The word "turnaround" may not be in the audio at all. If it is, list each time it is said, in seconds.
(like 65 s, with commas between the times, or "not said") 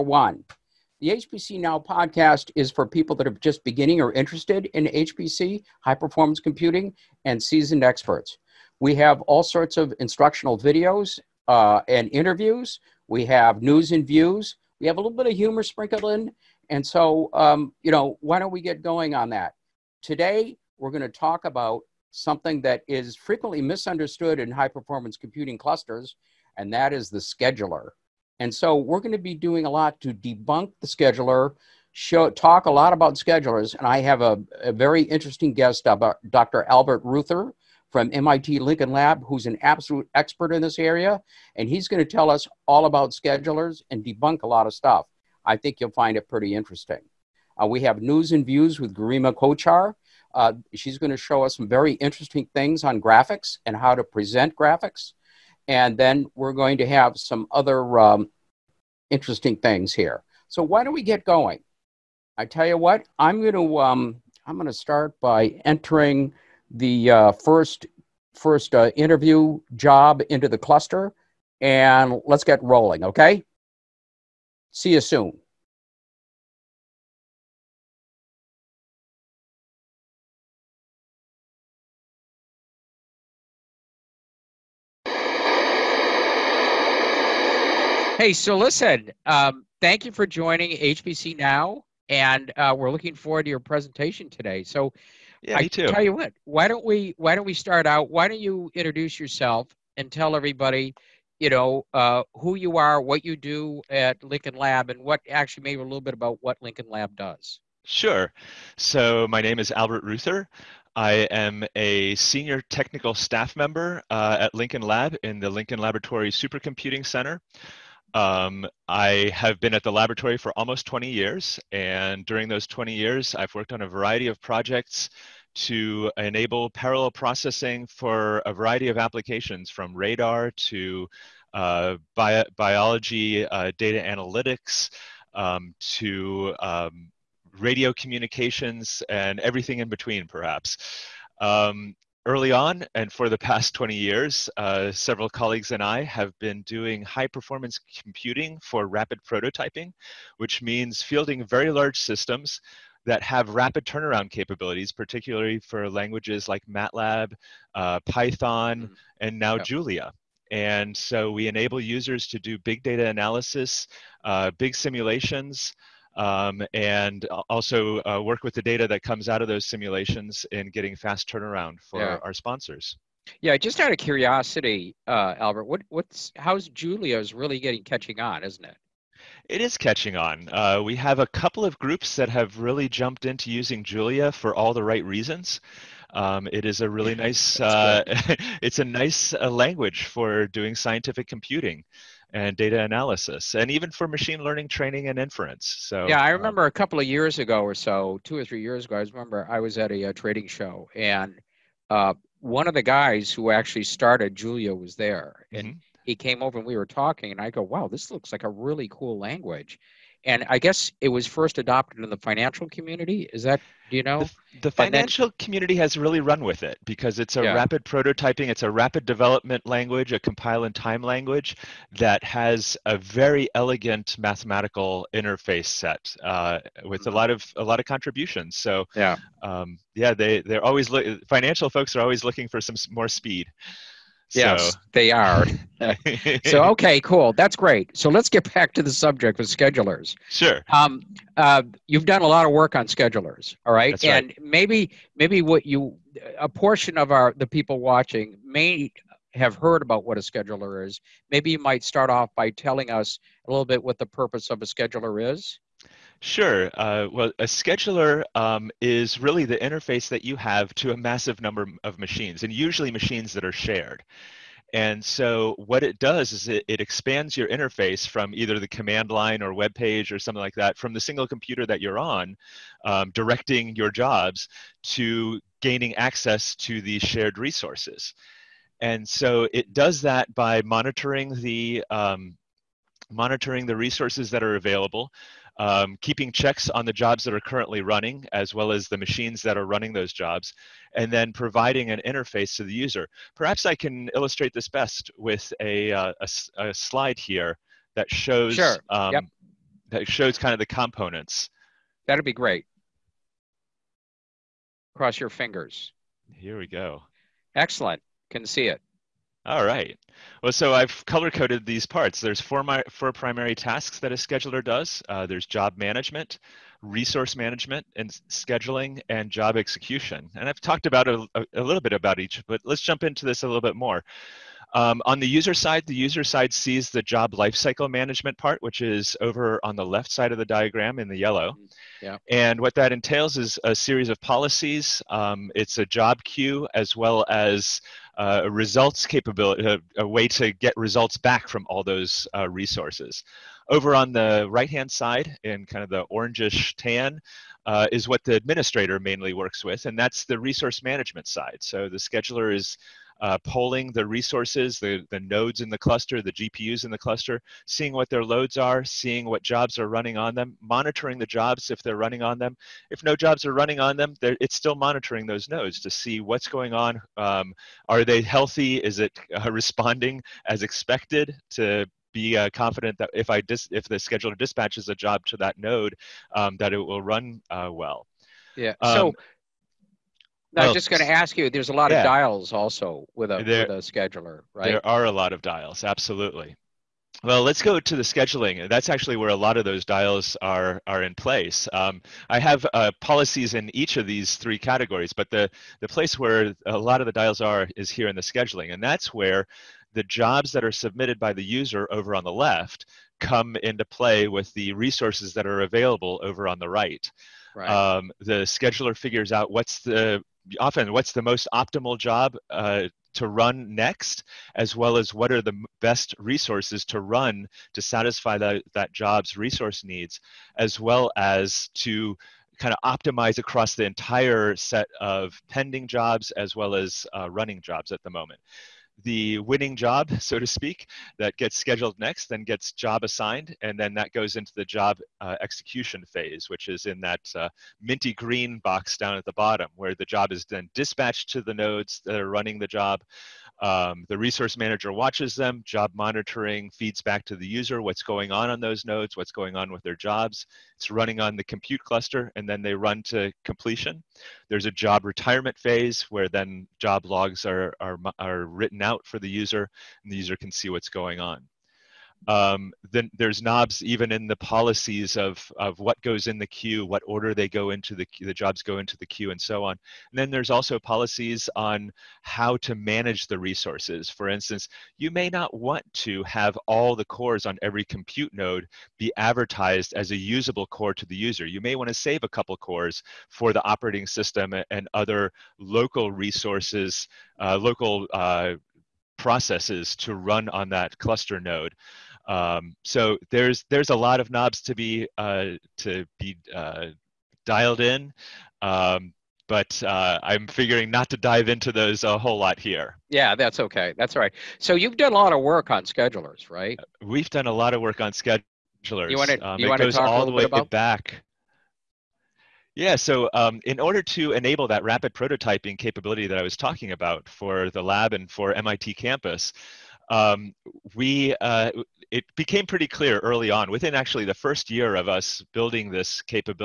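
153 s, 171 s.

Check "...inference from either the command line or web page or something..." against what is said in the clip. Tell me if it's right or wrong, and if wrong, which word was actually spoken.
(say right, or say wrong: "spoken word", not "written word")
wrong: "interface", not "inference".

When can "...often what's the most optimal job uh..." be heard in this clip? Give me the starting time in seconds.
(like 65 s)
410 s.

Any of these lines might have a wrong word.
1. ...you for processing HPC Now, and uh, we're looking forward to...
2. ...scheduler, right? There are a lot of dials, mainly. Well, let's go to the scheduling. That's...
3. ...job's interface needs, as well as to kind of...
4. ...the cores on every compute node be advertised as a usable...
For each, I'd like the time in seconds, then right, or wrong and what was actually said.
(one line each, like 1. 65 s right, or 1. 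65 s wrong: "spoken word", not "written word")
1. 90 s wrong: "joining", not "processing"
2. 383 s wrong: "absolutely", not "mainly"
3. 418 s wrong: "resource", not "interface"
4. 476 s right.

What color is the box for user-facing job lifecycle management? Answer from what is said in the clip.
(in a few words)
Yellow.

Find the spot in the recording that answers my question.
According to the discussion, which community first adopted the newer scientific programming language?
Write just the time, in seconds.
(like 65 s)
212 s.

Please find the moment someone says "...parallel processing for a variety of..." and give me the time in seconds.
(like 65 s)
126 s.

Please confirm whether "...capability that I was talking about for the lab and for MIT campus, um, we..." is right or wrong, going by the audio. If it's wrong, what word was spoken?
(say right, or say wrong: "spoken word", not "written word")
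right.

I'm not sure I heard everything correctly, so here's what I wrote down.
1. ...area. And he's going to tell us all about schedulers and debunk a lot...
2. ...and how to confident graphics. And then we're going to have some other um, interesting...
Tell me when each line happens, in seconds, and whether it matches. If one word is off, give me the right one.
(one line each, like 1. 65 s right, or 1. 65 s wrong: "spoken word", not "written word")
1. 40 s right
2. 53 s wrong: "present", not "confident".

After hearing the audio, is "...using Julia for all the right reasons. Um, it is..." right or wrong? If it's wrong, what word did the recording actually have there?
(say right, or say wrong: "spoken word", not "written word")
right.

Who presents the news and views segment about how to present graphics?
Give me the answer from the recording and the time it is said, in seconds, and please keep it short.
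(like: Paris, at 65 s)
Garima Kochhar, at 48 s.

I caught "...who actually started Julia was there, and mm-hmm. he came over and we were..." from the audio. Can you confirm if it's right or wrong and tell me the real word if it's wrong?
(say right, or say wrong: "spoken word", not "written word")
right.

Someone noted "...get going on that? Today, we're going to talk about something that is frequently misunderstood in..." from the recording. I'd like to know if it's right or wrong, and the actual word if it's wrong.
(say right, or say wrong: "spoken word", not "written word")
right.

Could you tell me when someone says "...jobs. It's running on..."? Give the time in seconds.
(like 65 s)
449 s.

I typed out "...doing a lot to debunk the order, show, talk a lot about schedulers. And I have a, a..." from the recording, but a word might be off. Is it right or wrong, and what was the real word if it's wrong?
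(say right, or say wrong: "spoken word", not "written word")
wrong: "scheduler", not "order".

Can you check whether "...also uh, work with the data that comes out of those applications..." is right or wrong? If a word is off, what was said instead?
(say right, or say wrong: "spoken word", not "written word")
wrong: "simulations", not "applications".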